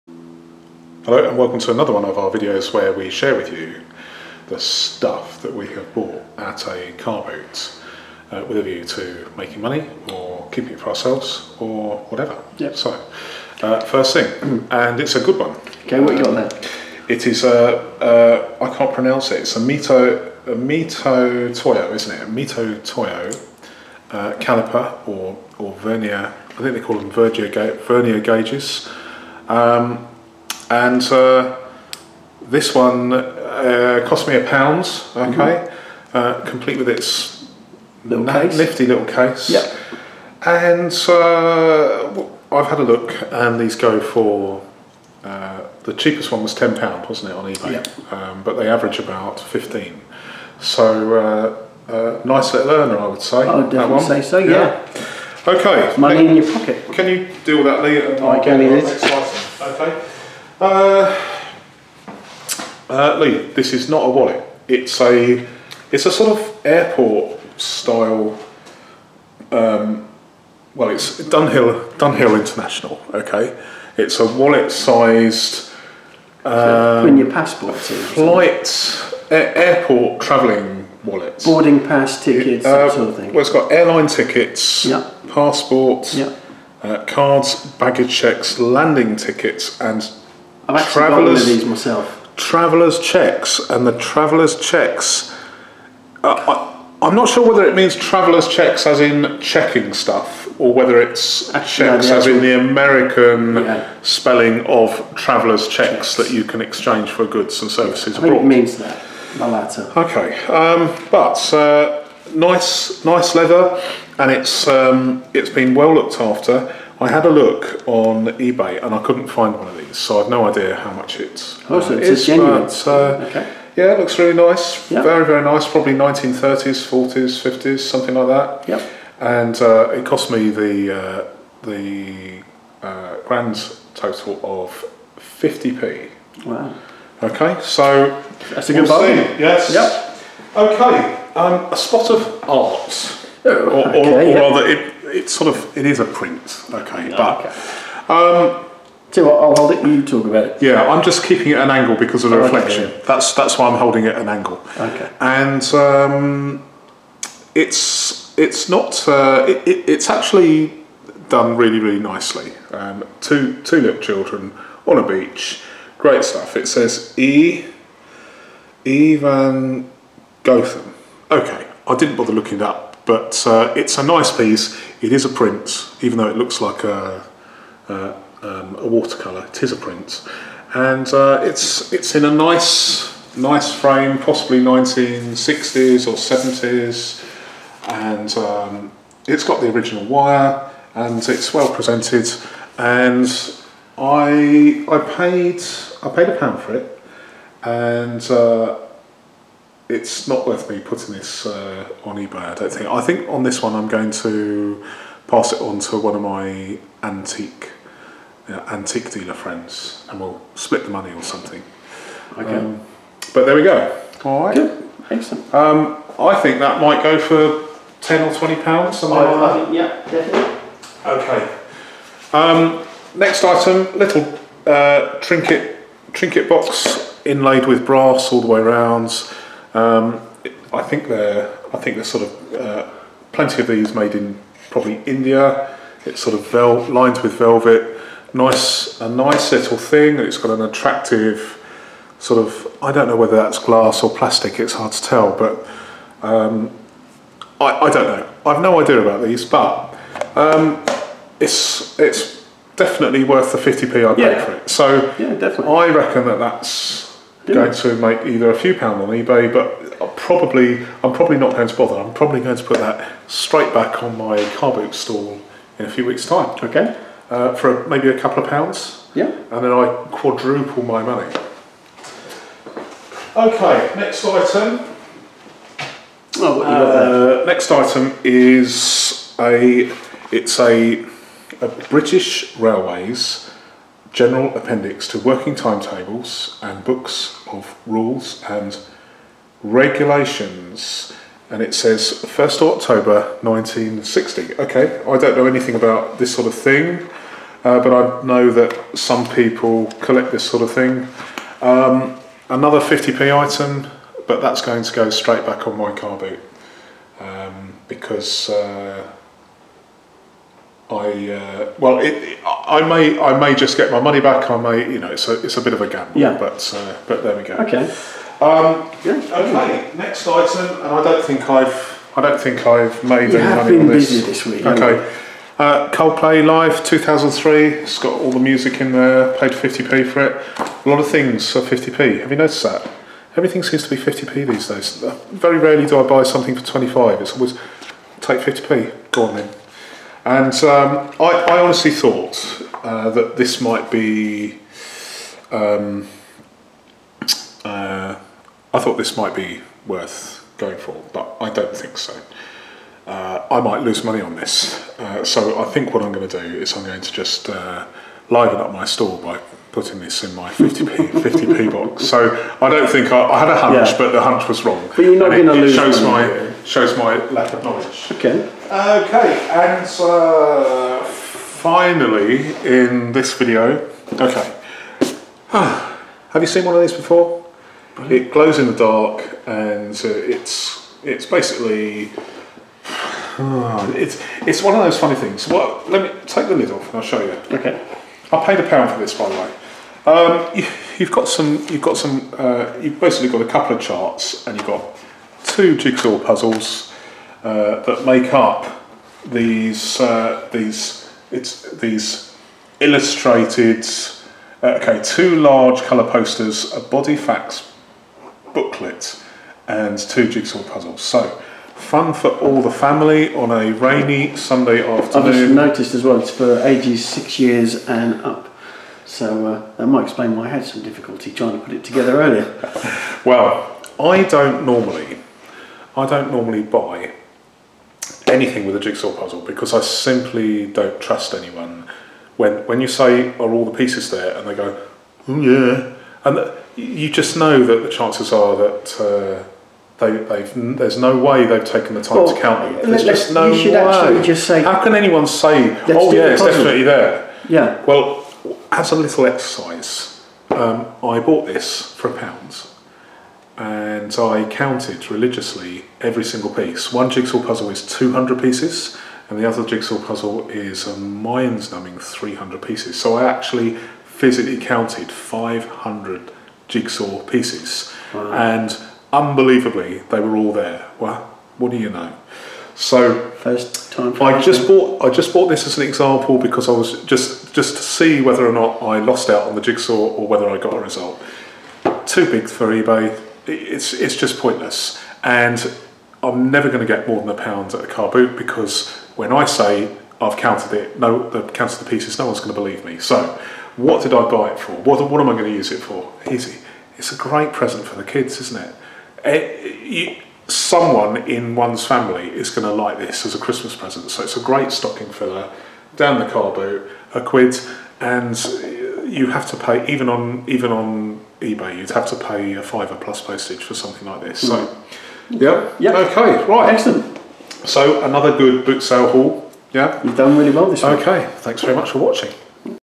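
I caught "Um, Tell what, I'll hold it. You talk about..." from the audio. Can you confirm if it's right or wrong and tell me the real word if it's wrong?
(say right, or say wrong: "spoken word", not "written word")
right.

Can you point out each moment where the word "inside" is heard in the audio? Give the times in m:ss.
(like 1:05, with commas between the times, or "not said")
not said.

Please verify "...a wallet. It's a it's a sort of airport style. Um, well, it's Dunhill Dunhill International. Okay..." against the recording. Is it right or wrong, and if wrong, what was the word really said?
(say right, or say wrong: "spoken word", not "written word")
right.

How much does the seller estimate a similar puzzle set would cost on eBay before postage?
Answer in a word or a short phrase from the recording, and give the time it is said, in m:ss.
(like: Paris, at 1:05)
£5, at 8:32.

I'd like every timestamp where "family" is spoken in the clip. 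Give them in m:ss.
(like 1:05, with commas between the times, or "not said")
6:52, 8:21.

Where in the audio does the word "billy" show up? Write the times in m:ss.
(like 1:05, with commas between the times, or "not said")
not said.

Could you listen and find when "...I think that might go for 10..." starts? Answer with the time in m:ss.
3:36.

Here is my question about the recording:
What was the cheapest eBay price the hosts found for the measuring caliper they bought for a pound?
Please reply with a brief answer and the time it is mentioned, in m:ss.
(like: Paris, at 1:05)
£10, at 0:46.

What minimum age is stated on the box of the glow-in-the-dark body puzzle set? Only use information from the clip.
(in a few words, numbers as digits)
6.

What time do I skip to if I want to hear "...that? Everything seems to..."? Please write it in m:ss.
5:32.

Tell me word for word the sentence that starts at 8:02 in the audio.
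Too big for eBay, it's, it's just pointless.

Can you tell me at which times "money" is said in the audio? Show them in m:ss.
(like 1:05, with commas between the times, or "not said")
0:09, 0:55, 3:30, 4:31, 5:13, 5:23, 5:54, 6:06.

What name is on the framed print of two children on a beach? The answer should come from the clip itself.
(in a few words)
E. Evan Gotham.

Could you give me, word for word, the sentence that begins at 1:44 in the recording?
spelling of travelers' checks, checks, that you can exchange for goods and services I think it means that, the latter.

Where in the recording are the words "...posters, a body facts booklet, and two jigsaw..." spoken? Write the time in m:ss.
6:46.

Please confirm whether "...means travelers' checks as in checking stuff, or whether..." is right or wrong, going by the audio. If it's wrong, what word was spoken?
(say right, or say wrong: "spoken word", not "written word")
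right.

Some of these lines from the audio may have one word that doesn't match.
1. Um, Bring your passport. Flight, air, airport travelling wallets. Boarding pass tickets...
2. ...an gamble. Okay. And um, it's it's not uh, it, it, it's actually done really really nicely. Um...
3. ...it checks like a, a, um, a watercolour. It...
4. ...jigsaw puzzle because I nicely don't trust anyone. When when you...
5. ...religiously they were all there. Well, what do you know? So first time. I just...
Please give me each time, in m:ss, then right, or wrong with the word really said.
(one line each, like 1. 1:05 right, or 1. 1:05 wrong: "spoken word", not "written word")
1. 1:16 right
2. 2:34 wrong: "angle", not "gamble"
3. 2:56 wrong: "looks", not "checks"
4. 7:08 wrong: "simply", not "nicely"
5. 7:49 wrong: "unbelievably", not "religiously".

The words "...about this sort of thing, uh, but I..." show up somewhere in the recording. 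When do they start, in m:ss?
4:55.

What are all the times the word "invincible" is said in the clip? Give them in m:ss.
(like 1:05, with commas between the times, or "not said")
not said.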